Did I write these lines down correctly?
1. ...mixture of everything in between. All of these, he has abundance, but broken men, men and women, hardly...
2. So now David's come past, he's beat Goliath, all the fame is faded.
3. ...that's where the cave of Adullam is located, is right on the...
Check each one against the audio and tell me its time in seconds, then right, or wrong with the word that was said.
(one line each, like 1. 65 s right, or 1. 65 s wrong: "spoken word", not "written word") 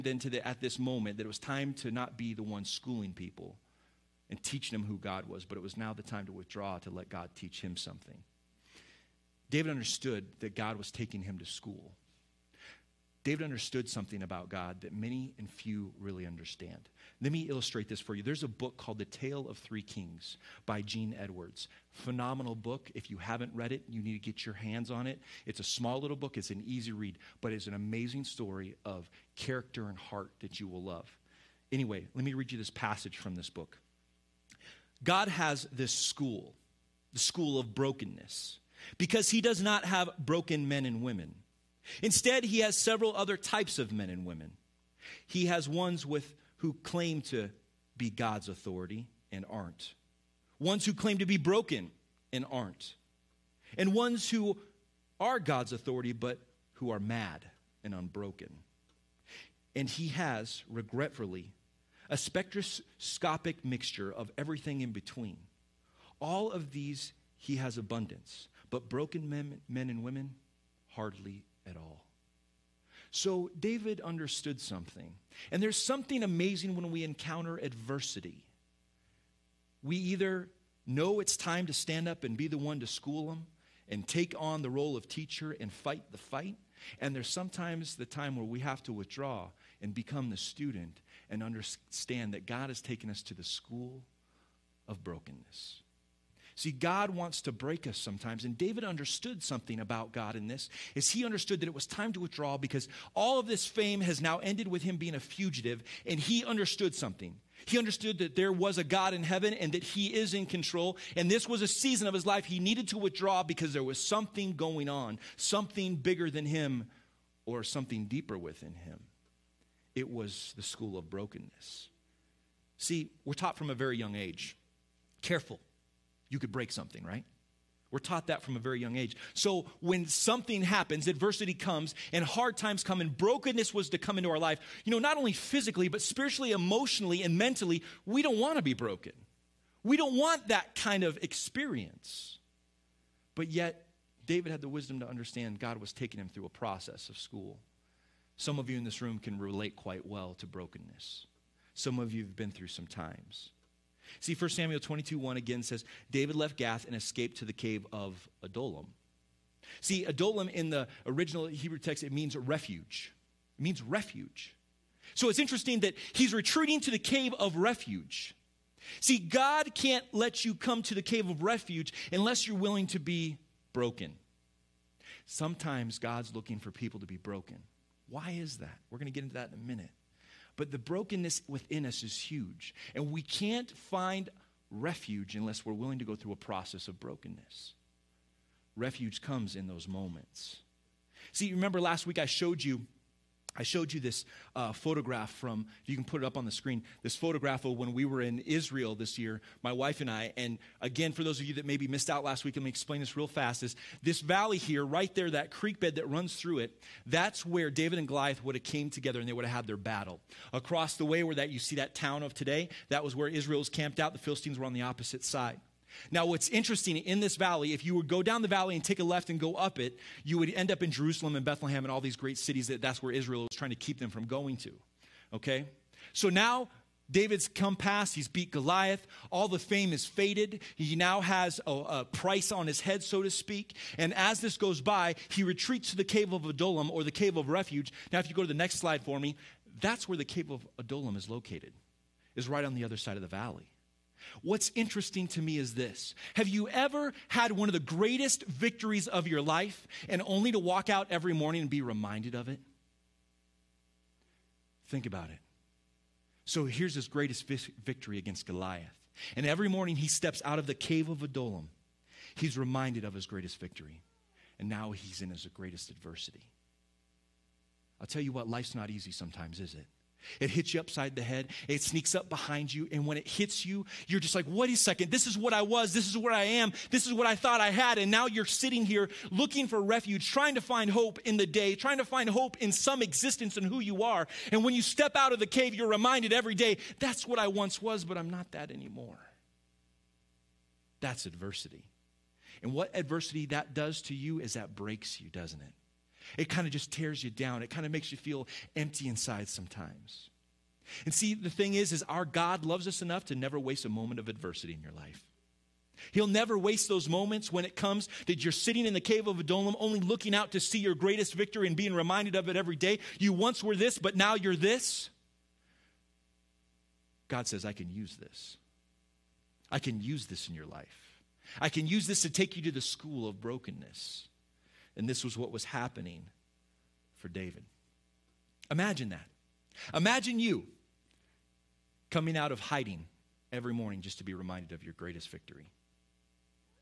1. 63 s right
2. 226 s right
3. 239 s right.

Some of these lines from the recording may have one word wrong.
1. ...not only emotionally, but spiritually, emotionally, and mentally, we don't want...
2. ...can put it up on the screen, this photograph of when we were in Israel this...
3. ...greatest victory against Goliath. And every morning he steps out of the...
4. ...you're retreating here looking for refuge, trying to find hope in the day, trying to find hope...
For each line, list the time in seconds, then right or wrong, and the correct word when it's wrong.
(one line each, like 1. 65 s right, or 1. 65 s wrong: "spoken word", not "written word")
1. 134 s wrong: "physically", not "emotionally"
2. 195 s right
3. 257 s right
4. 278 s wrong: "sitting", not "retreating".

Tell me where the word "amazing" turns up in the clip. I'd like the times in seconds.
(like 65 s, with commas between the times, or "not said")
27 s, 76 s.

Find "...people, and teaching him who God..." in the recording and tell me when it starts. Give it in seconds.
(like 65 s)
3 s.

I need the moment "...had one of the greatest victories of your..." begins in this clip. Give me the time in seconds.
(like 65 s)
247 s.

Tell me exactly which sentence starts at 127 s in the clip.
We're taught that from a very young age.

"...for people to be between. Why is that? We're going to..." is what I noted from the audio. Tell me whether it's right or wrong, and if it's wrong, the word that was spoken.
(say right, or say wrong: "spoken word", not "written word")
wrong: "broken", not "between".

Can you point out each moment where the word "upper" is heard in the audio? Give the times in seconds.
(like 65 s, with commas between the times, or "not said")
not said.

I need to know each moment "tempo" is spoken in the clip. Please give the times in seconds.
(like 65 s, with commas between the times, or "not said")
not said.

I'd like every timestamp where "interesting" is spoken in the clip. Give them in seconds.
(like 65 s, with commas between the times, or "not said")
165 s, 216 s, 244 s.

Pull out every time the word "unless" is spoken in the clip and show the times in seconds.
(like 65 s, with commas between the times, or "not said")
172 s, 185 s.